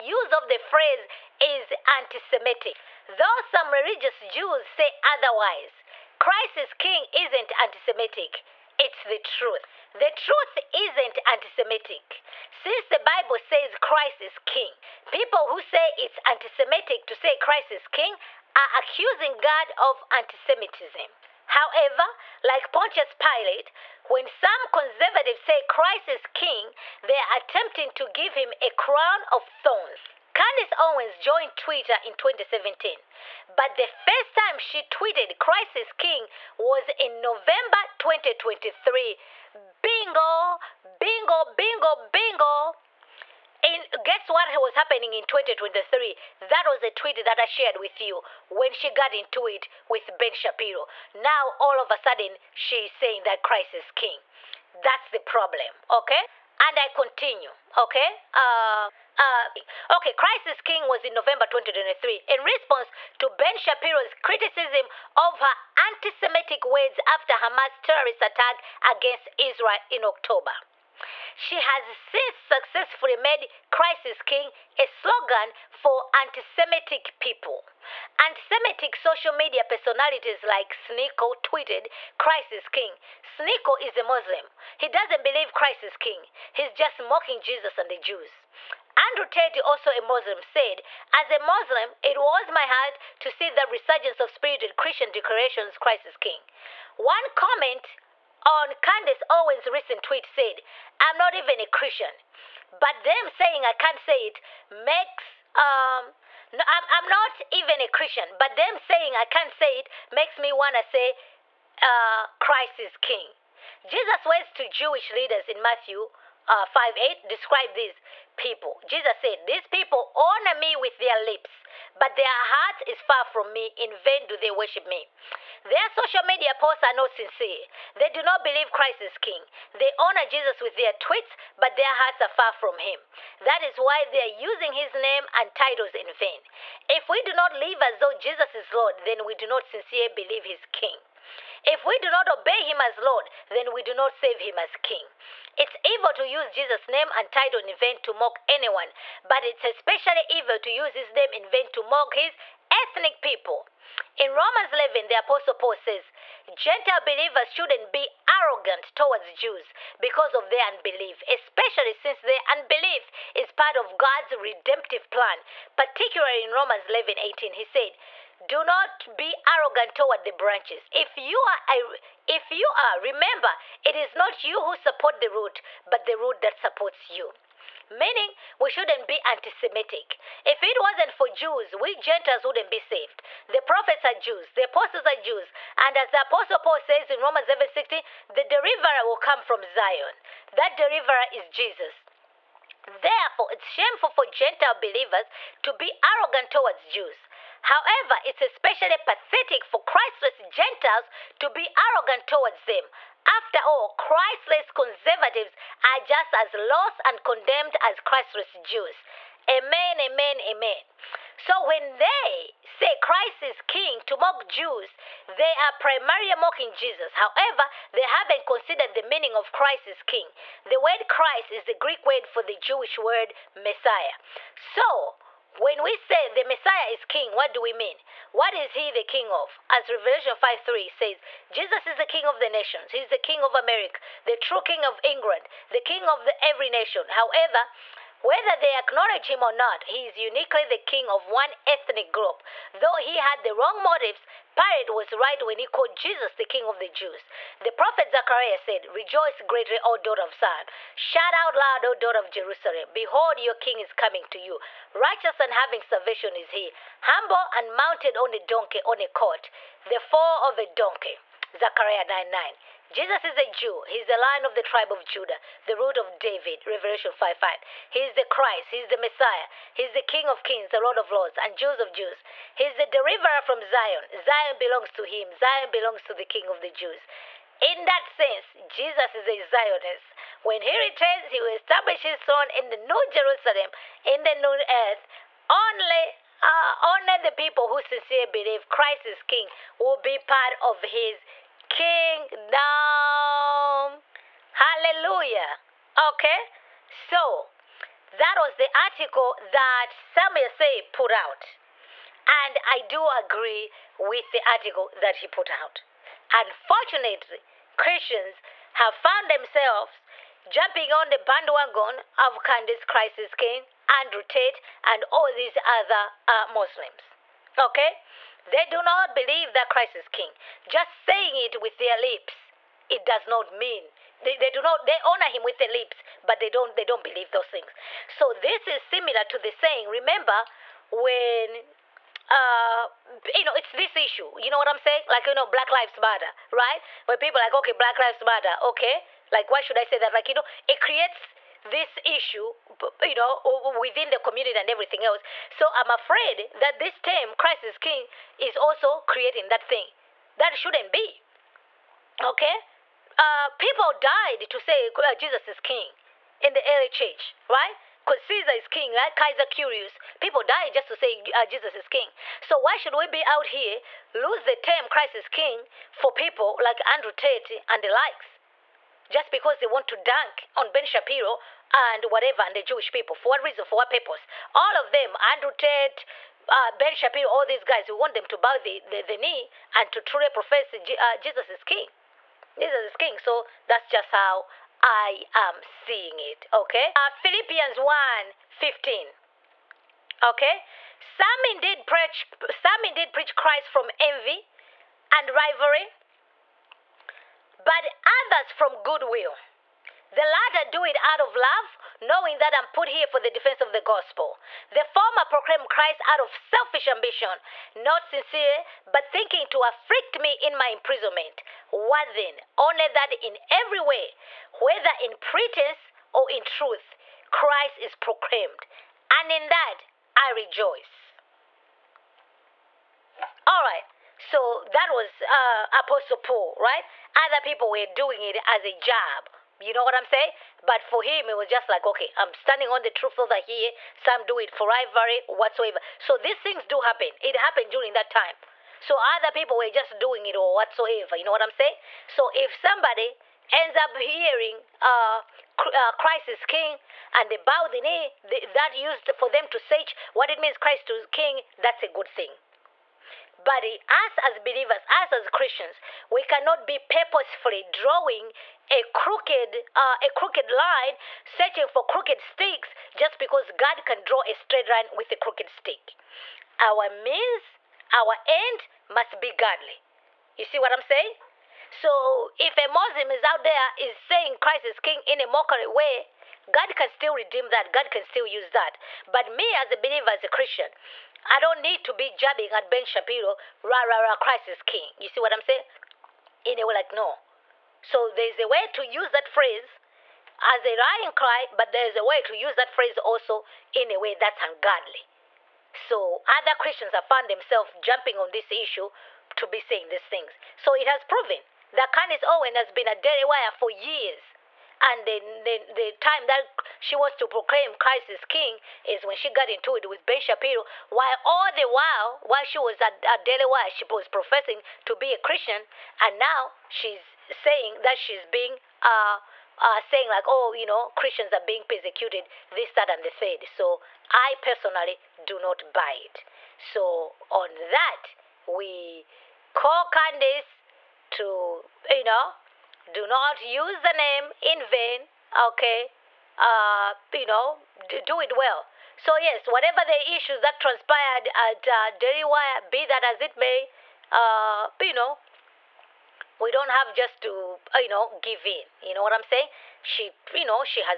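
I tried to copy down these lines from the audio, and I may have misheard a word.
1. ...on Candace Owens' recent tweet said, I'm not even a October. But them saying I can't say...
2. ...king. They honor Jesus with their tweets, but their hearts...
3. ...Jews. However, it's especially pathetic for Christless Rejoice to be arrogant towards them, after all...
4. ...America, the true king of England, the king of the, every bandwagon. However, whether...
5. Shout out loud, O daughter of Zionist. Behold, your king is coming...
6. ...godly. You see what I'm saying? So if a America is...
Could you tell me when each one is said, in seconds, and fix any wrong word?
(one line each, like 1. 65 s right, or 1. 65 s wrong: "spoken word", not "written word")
1. 98 s wrong: "Christian", not "October"
2. 129 s right
3. 196 s wrong: "Gentiles", not "Rejoice"
4. 233 s wrong: "nation", not "bandwagon"
5. 250 s wrong: "Jerusalem", not "Zionist"
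6. 469 s wrong: "Muslim", not "America".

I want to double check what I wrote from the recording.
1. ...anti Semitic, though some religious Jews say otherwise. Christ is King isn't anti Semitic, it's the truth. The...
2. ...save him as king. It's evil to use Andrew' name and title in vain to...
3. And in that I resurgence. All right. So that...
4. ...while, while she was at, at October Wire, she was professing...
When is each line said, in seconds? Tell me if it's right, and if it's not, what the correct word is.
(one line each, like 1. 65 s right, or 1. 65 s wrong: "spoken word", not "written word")
1. 1 s right
2. 144 s wrong: "Jesus", not "Andrew"
3. 419 s wrong: "rejoice", not "resurgence"
4. 511 s wrong: "Daily", not "October".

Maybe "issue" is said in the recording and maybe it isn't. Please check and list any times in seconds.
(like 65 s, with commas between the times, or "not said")
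333 s, 342 s, 498 s, 540 s.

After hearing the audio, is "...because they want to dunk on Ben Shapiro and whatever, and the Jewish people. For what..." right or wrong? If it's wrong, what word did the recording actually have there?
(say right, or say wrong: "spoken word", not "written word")
right.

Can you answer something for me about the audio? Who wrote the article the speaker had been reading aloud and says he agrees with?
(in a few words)
Samuel Sey.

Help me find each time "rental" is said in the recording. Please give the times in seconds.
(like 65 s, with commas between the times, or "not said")
not said.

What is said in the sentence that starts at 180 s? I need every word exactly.
If it wasn't for Jews, we Gentiles wouldn't be saved.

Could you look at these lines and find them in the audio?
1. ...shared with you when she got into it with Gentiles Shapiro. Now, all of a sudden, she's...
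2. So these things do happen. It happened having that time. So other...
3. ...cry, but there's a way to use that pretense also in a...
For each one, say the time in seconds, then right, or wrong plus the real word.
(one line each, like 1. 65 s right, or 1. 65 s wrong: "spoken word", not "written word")
1. 47 s wrong: "Ben", not "Gentiles"
2. 435 s wrong: "during", not "having"
3. 491 s wrong: "phrase", not "pretense".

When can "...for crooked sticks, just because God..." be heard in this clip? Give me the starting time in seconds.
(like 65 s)
461 s.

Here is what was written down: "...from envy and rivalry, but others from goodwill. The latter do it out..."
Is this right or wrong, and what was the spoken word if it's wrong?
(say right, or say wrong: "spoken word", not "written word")
right.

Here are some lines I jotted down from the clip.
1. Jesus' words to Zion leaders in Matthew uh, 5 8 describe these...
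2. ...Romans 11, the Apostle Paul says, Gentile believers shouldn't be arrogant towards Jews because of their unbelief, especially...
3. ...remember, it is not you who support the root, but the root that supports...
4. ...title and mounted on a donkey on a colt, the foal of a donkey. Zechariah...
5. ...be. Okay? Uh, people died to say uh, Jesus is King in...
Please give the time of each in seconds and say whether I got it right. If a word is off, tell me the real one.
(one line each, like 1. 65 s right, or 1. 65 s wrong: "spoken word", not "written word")
1. 113 s wrong: "Jewish", not "Zion"
2. 154 s right
3. 172 s right
4. 257 s wrong: "humble", not "title"
5. 350 s right.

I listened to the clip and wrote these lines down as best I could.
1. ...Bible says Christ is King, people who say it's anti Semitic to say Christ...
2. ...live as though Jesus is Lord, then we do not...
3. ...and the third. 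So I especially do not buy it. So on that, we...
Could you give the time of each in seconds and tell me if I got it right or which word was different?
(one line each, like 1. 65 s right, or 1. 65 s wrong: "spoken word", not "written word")
1. 12 s right
2. 137 s right
3. 522 s wrong: "personally", not "especially".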